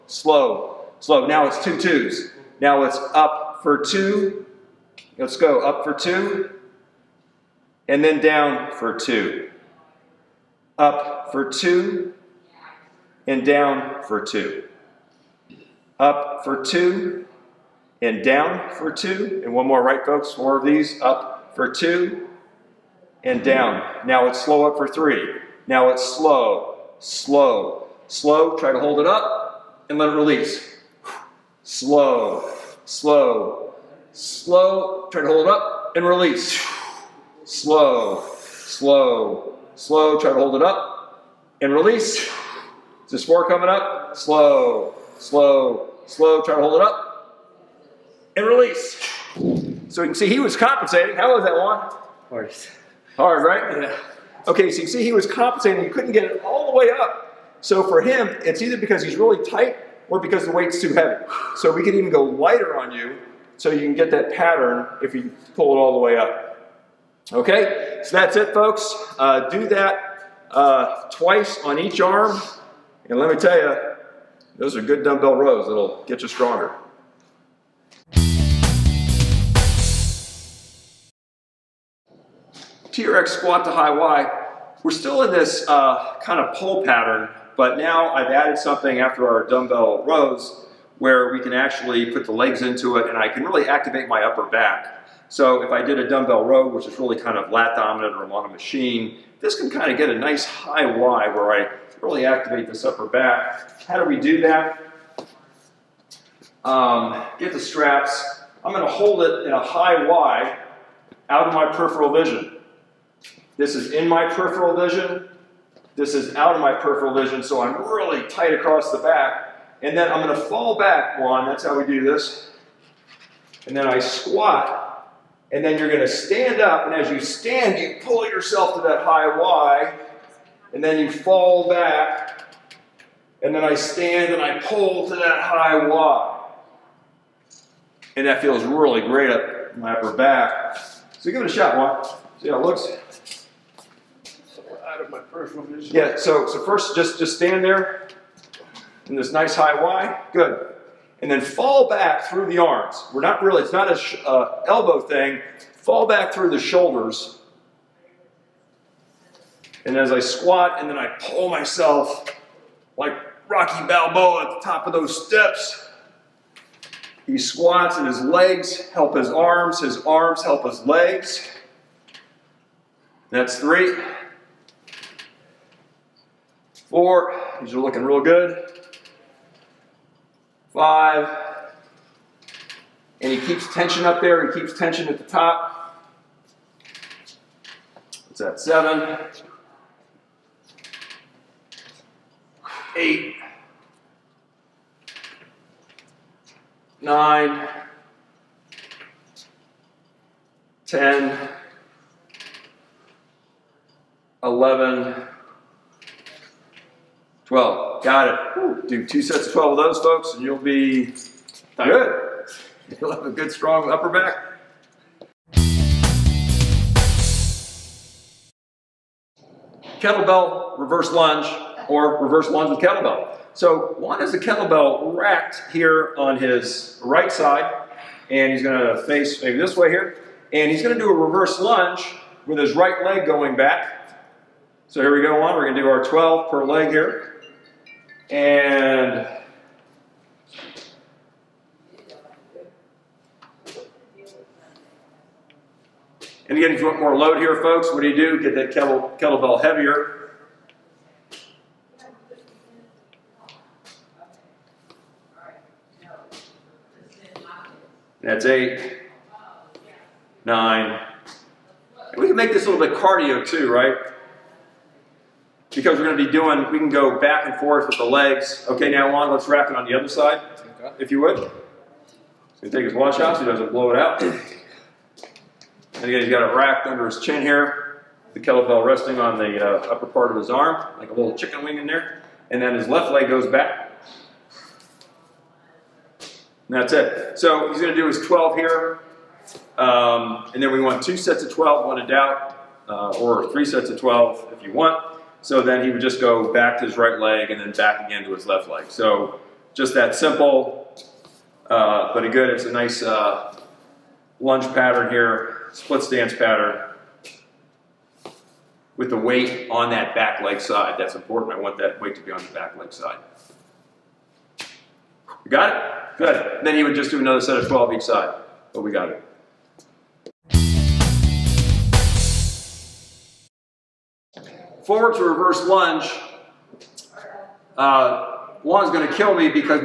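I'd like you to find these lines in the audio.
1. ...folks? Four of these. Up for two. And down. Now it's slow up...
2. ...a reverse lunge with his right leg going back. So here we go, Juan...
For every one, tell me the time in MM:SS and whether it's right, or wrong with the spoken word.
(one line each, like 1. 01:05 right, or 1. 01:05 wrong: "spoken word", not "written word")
1. 00:20 right
2. 03:51 right.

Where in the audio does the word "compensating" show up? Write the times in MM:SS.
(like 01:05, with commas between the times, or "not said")
00:50, 00:55.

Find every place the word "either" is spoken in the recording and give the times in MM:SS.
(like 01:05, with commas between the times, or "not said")
00:58.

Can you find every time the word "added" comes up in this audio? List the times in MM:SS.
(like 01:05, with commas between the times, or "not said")
01:28.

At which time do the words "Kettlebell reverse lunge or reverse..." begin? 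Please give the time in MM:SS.
03:39.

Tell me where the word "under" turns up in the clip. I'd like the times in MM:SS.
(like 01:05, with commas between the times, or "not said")
04:36.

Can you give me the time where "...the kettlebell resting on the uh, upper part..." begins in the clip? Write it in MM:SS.
04:38.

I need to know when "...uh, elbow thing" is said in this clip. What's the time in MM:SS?
02:34.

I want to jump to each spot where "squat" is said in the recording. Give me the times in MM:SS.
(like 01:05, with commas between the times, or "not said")
01:23, 02:03, 02:40, 02:47.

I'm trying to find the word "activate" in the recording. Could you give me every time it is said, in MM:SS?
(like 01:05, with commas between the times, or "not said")
01:33, 01:42.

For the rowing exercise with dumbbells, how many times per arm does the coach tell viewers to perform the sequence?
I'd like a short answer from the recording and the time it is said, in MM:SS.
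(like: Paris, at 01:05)
twice, at 01:11.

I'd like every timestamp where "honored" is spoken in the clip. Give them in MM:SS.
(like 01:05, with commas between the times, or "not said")
not said.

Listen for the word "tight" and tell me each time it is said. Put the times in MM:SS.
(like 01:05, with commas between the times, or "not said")
00:59, 01:58.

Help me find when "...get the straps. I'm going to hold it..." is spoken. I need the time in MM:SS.
01:47.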